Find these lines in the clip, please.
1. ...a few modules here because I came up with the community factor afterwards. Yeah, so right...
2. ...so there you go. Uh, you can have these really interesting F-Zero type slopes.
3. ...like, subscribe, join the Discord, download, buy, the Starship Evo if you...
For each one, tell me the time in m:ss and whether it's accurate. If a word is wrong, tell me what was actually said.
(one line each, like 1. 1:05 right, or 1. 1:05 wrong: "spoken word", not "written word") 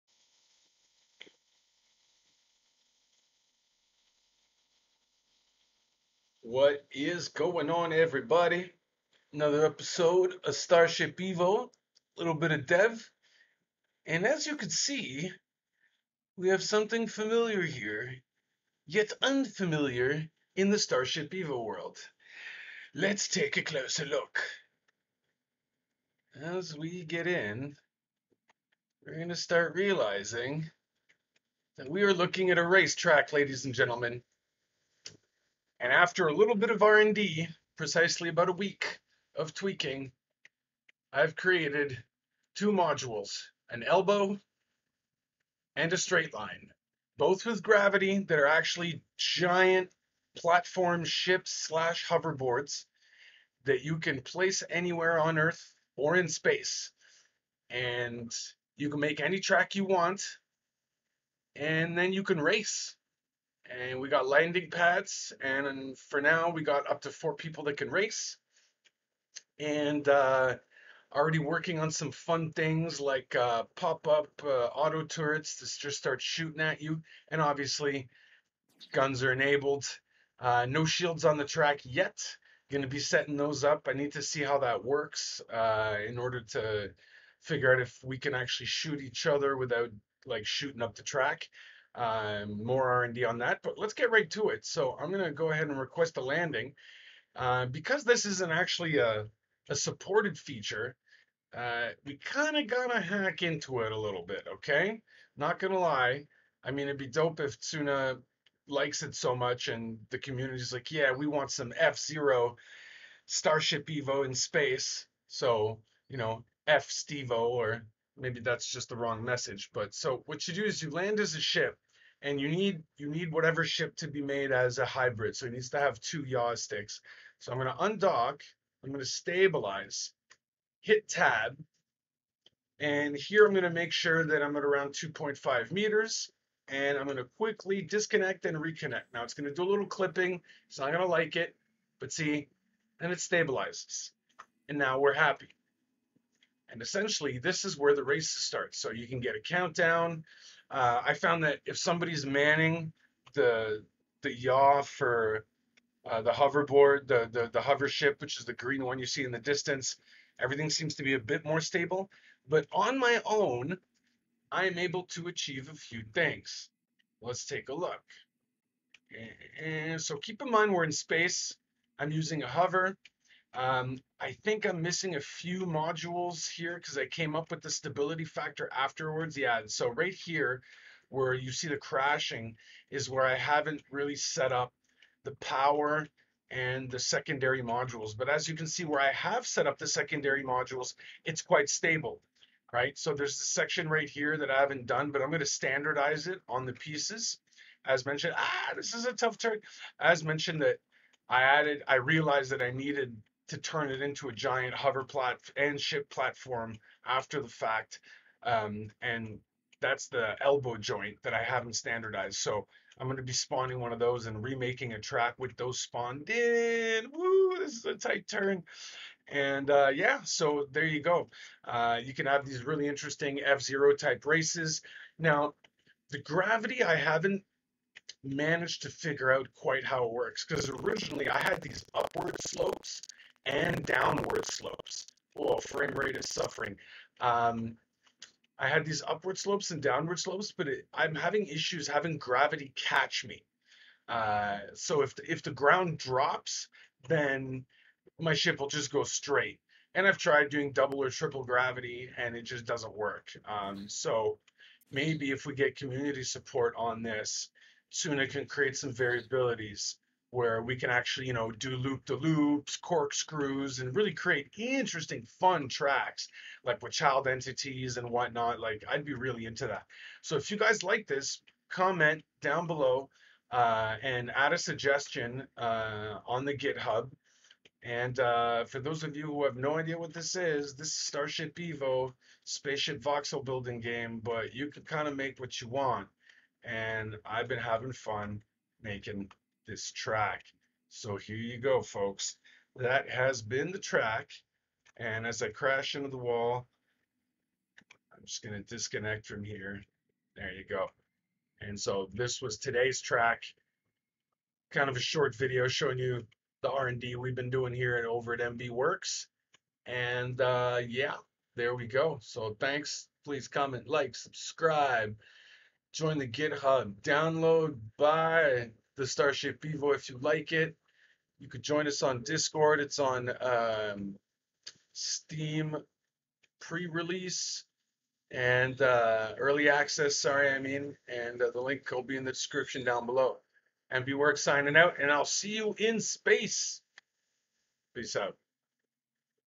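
1. 2:55 wrong: "stability", not "community"
2. 3:40 wrong: "races", not "slopes"
3. 5:13 wrong: "GitHub", not "Discord".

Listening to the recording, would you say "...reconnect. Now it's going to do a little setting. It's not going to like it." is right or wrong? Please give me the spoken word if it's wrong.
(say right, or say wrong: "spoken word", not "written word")
wrong: "clipping", not "setting".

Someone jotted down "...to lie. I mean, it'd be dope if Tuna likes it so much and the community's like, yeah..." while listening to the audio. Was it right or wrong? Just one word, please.
right.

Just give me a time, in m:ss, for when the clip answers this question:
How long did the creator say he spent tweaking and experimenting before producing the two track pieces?
0:38.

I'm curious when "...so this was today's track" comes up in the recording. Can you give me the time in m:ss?
5:01.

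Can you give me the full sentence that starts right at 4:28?
Like, I'd be really into that.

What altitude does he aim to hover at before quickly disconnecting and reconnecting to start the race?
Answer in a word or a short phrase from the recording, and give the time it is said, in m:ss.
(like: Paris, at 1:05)
2.5 meters, at 2:14.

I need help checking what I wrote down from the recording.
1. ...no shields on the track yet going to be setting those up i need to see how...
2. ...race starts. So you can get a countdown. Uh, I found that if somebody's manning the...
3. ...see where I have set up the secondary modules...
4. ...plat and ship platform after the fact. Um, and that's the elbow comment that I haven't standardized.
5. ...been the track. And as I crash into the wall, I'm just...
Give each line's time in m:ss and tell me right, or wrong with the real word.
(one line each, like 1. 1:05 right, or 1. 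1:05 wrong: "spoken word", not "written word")
1. 1:20 right
2. 2:28 right
3. 3:08 right
4. 3:25 wrong: "joint", not "comment"
5. 4:53 right.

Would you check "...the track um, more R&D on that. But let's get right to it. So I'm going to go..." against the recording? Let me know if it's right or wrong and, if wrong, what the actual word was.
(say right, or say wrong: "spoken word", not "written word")
right.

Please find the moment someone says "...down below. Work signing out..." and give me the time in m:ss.
5:32.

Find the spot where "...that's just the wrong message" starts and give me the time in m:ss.
1:58.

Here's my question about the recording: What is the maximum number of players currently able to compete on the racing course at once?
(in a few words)
4.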